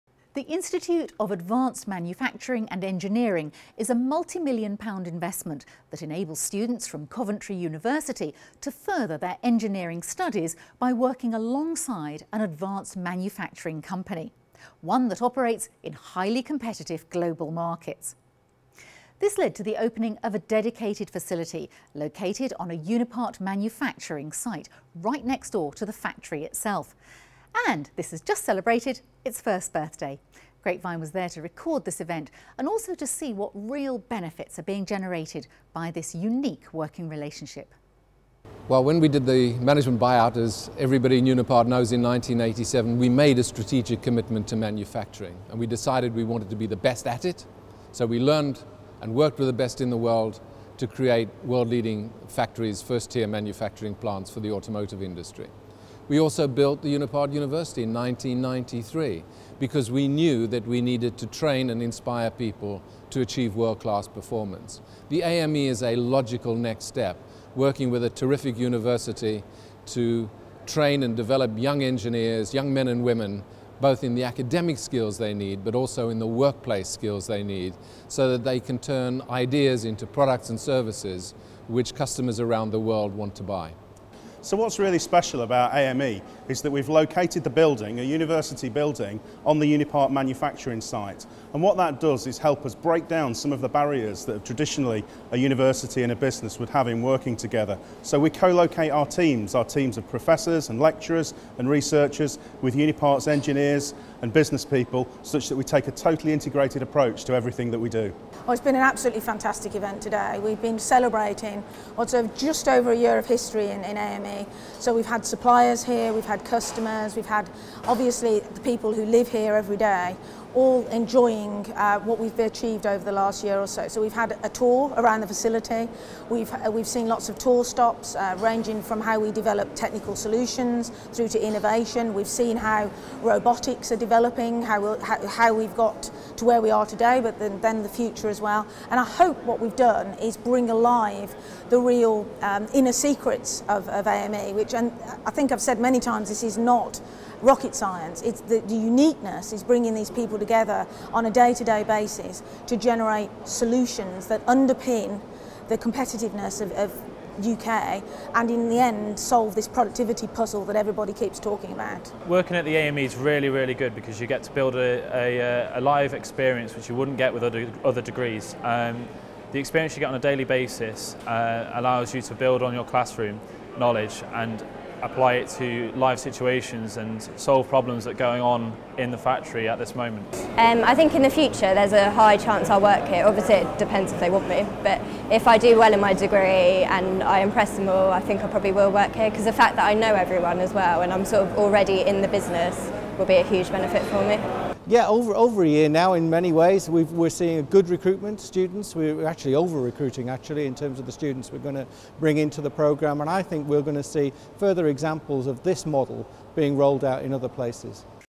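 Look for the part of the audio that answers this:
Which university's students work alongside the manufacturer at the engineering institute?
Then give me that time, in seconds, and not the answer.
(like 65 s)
7 s.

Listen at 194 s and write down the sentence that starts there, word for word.
Yeah, over, over a year now in many ways.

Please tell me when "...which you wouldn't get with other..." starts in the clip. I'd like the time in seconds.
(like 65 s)
166 s.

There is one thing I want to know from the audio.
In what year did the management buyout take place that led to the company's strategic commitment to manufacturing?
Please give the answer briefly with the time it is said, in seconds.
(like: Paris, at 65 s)
1987, at 42 s.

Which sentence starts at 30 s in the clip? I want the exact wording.
Grapevine was there to record this event and also to see what real benefits are being generated by this unique working relationship.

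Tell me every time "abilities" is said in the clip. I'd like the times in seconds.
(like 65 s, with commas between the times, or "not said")
not said.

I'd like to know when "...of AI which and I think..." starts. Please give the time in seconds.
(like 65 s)
143 s.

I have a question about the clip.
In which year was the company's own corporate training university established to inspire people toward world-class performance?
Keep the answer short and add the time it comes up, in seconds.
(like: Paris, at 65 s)
1993, at 57 s.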